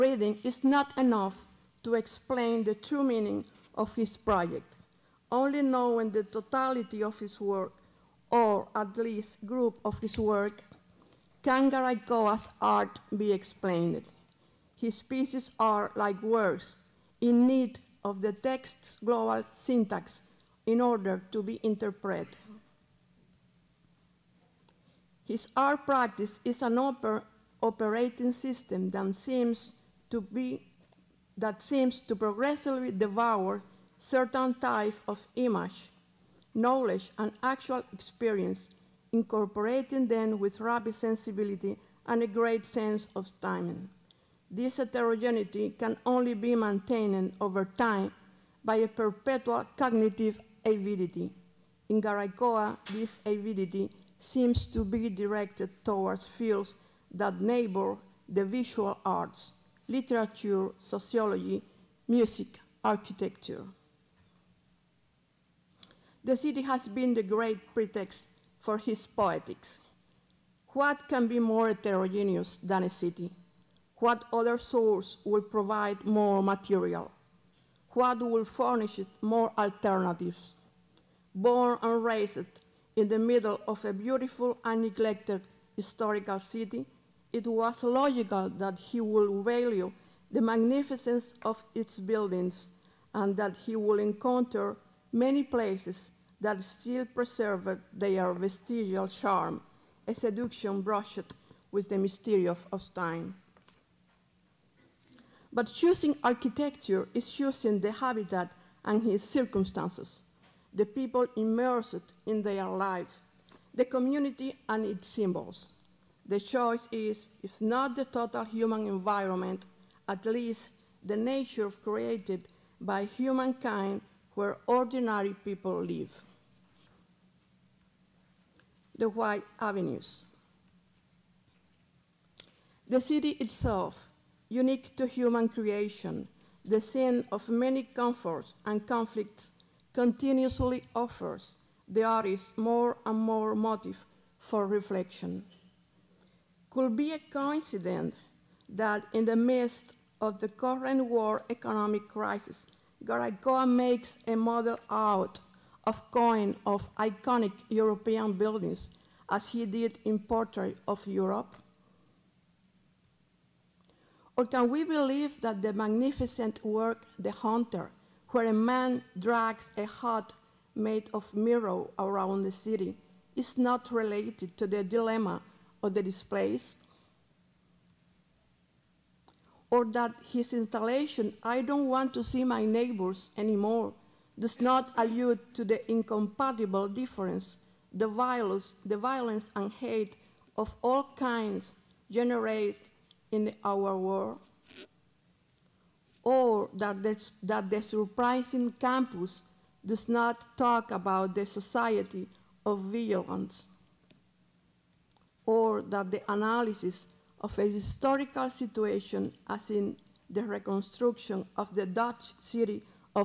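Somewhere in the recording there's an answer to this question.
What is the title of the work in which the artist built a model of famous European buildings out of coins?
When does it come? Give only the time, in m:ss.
2:40.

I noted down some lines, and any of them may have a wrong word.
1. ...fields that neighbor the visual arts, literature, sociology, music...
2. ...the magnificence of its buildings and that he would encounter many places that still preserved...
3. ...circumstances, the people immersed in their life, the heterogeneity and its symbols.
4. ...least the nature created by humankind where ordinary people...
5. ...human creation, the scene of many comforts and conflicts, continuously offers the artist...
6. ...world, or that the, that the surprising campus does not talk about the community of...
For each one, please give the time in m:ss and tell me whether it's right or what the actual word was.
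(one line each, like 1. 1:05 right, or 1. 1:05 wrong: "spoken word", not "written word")
1. 0:56 right
2. 1:30 right
3. 1:49 wrong: "community", not "heterogeneity"
4. 2:00 right
5. 2:15 right
6. 3:13 wrong: "society", not "community".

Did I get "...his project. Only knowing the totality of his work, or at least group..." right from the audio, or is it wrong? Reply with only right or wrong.
right.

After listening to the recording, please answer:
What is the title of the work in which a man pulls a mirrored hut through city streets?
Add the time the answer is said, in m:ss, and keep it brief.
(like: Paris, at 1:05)
The Hunter, at 2:47.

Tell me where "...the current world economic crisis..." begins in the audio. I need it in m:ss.
2:30.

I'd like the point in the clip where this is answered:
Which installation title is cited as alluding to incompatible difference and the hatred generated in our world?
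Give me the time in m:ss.
3:01.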